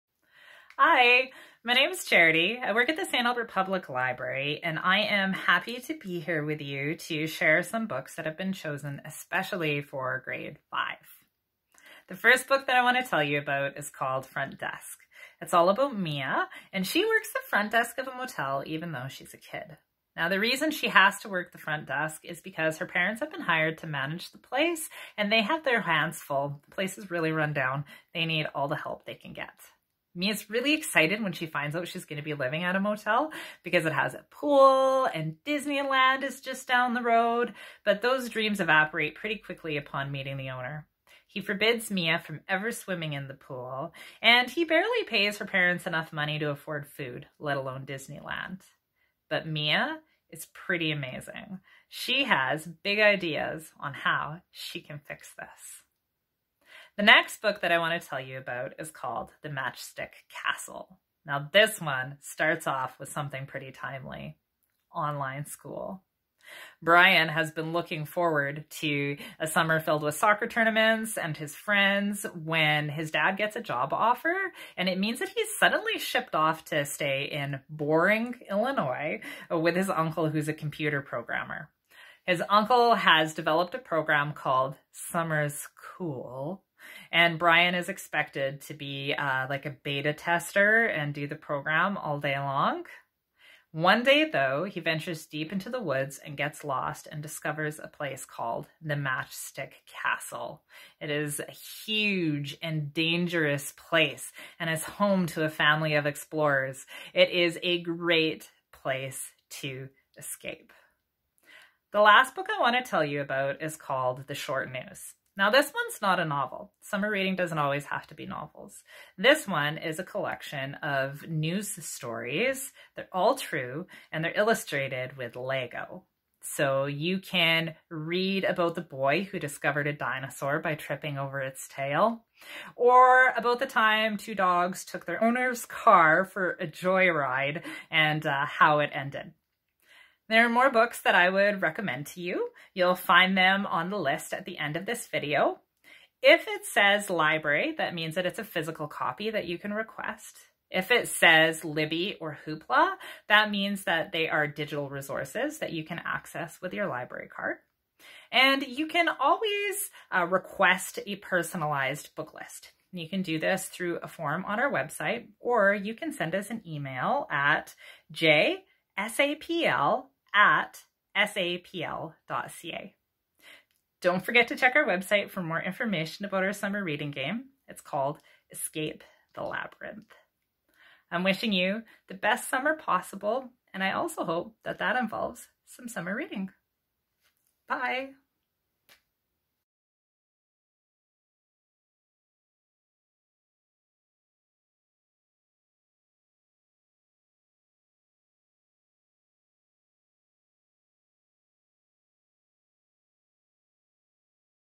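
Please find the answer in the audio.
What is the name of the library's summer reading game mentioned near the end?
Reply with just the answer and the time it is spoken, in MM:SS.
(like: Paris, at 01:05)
Escape the Labyrinth, at 02:58.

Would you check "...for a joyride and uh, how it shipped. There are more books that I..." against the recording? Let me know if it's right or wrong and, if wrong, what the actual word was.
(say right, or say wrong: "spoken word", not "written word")
wrong: "ended", not "shipped".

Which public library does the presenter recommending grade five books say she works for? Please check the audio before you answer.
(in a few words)
St. Albert Public Library.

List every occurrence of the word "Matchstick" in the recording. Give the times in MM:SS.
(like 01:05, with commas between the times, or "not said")
00:59, 01:38.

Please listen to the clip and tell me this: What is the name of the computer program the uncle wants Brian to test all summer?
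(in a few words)
Summer's Cool.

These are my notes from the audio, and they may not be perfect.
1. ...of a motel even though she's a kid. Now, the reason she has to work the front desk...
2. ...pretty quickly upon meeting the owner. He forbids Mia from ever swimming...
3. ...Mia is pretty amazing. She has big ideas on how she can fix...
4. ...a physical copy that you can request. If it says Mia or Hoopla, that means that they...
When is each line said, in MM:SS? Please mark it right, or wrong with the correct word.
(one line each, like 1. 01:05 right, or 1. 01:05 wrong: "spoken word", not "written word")
1. 00:17 right
2. 00:39 right
3. 00:49 right
4. 02:28 wrong: "Libby", not "Mia".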